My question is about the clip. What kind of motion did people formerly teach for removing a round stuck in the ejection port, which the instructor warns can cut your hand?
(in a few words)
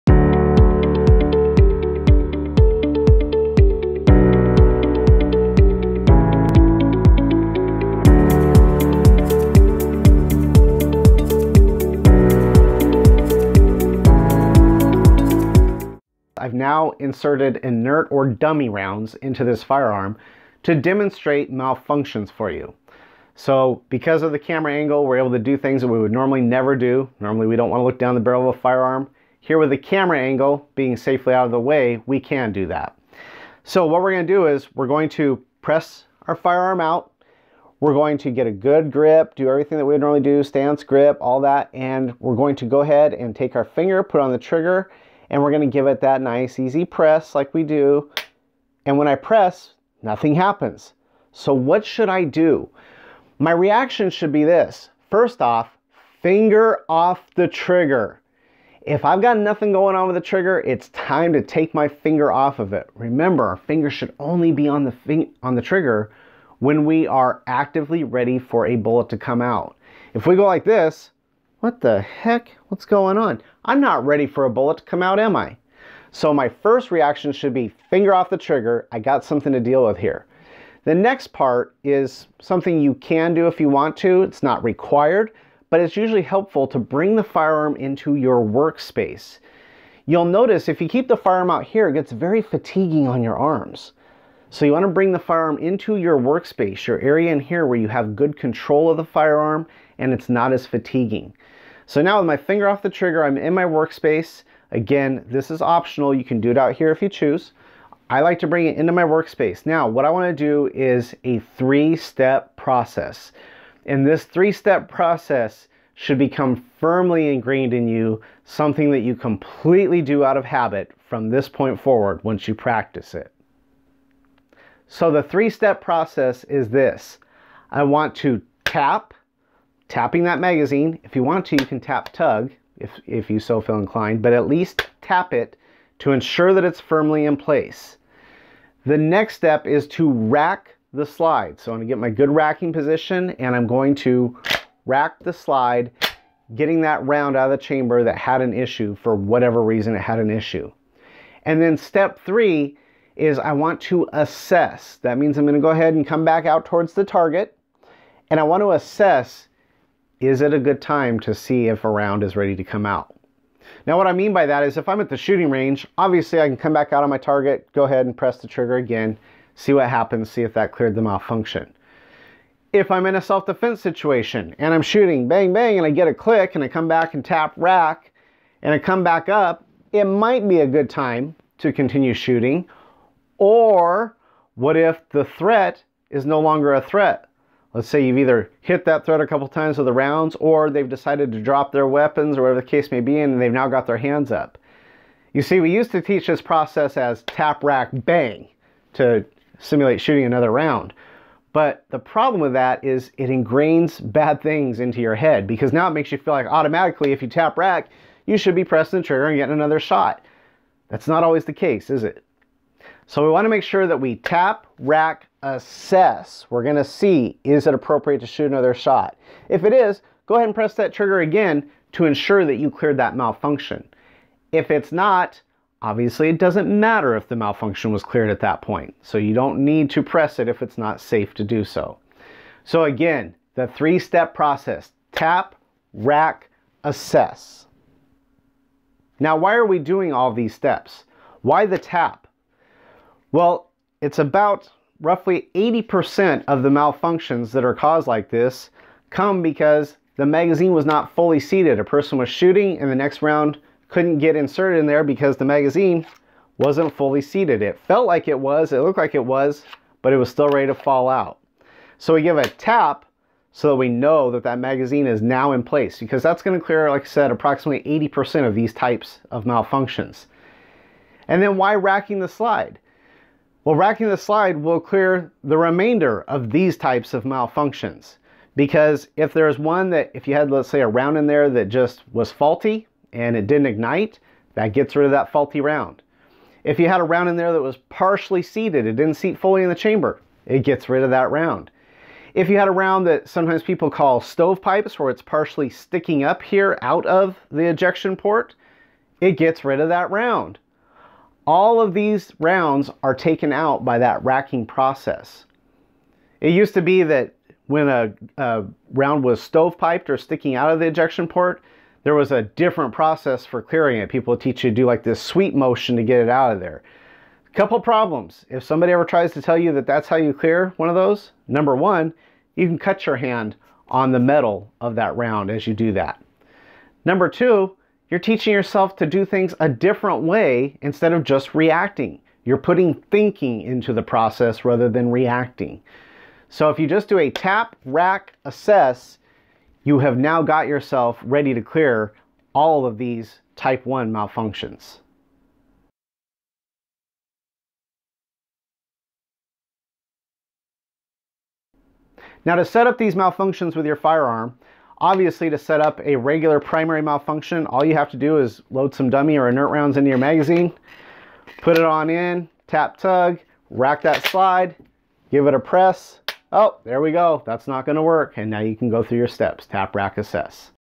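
sweep motion.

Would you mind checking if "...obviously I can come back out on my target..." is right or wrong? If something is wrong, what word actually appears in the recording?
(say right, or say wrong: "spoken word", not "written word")
right.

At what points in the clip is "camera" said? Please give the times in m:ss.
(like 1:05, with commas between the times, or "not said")
0:24, 0:29.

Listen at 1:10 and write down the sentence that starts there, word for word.
If we go like this, what the heck?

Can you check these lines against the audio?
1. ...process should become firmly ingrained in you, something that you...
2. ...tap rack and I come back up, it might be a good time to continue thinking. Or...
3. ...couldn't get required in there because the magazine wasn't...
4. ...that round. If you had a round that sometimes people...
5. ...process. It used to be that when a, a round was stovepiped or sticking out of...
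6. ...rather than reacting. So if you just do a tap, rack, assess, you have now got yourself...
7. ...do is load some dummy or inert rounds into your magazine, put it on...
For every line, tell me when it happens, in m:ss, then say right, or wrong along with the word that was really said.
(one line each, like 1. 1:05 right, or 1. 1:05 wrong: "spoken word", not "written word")
1. 1:54 right
2. 2:57 wrong: "shooting", not "thinking"
3. 4:13 wrong: "inserted", not "required"
4. 4:51 right
5. 5:04 right
6. 5:34 right
7. 5:58 right.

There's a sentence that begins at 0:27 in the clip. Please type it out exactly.
Normally we don't want to look down the barrel of a firearm.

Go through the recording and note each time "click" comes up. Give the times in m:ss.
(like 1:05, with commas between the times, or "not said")
2:56.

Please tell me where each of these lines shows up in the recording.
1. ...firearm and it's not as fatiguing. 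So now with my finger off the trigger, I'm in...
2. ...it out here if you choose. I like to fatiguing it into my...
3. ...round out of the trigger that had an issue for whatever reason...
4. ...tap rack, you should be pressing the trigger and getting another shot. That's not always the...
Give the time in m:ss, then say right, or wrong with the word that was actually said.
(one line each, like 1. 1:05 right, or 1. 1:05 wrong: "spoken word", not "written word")
1. 1:39 right
2. 1:46 wrong: "bring", not "fatiguing"
3. 2:27 wrong: "chamber", not "trigger"
4. 3:27 right.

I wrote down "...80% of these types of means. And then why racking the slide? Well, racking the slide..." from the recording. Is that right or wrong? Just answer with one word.
wrong.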